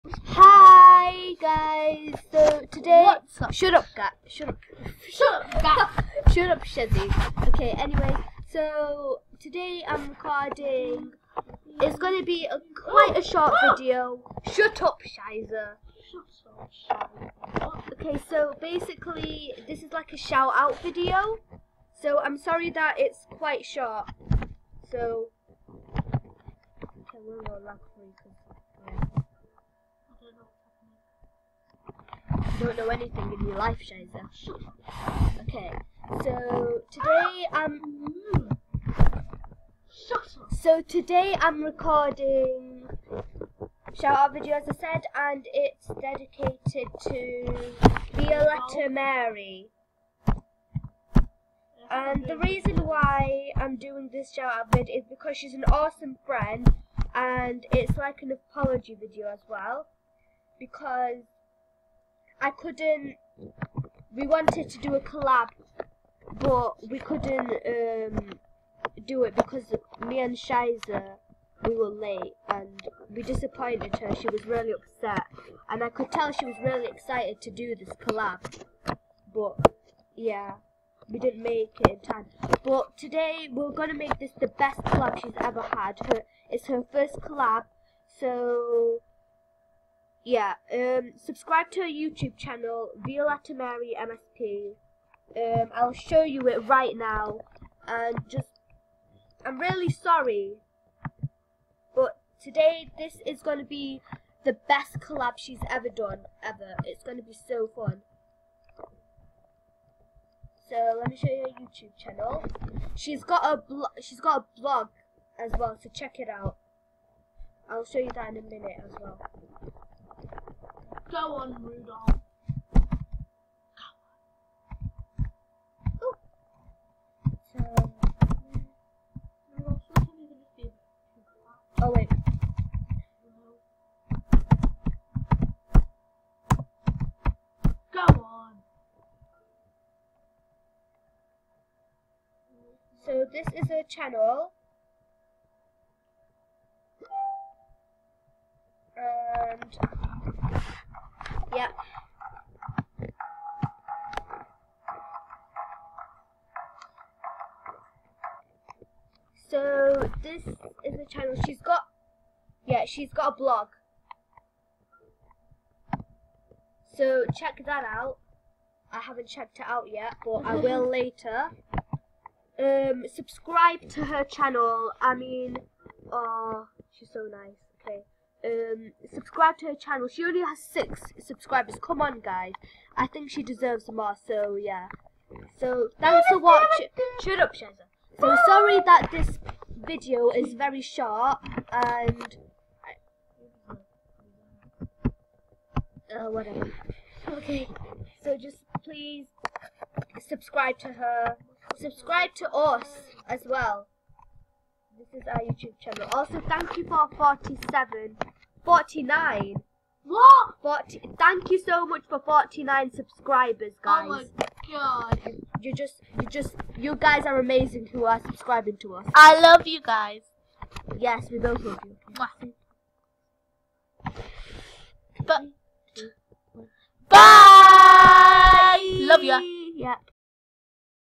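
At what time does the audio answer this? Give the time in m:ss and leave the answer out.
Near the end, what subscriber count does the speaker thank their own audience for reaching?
3:32.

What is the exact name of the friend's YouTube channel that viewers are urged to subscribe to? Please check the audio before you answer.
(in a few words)
Violetta Marie MSP.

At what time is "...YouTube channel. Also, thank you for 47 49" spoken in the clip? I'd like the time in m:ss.
3:25.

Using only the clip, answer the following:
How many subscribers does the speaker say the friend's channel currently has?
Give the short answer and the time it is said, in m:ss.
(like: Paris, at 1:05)
6, at 3:00.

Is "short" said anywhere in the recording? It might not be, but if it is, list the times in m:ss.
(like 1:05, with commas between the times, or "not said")
0:13, 0:23, 3:10.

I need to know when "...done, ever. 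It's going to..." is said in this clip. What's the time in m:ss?
1:45.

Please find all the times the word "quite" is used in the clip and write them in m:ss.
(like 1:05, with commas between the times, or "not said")
0:12, 0:23.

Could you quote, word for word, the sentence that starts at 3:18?
So just please subscribe to her.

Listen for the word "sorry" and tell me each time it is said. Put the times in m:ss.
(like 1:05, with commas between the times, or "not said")
0:22, 1:39, 3:08.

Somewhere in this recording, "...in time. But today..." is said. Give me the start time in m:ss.
1:21.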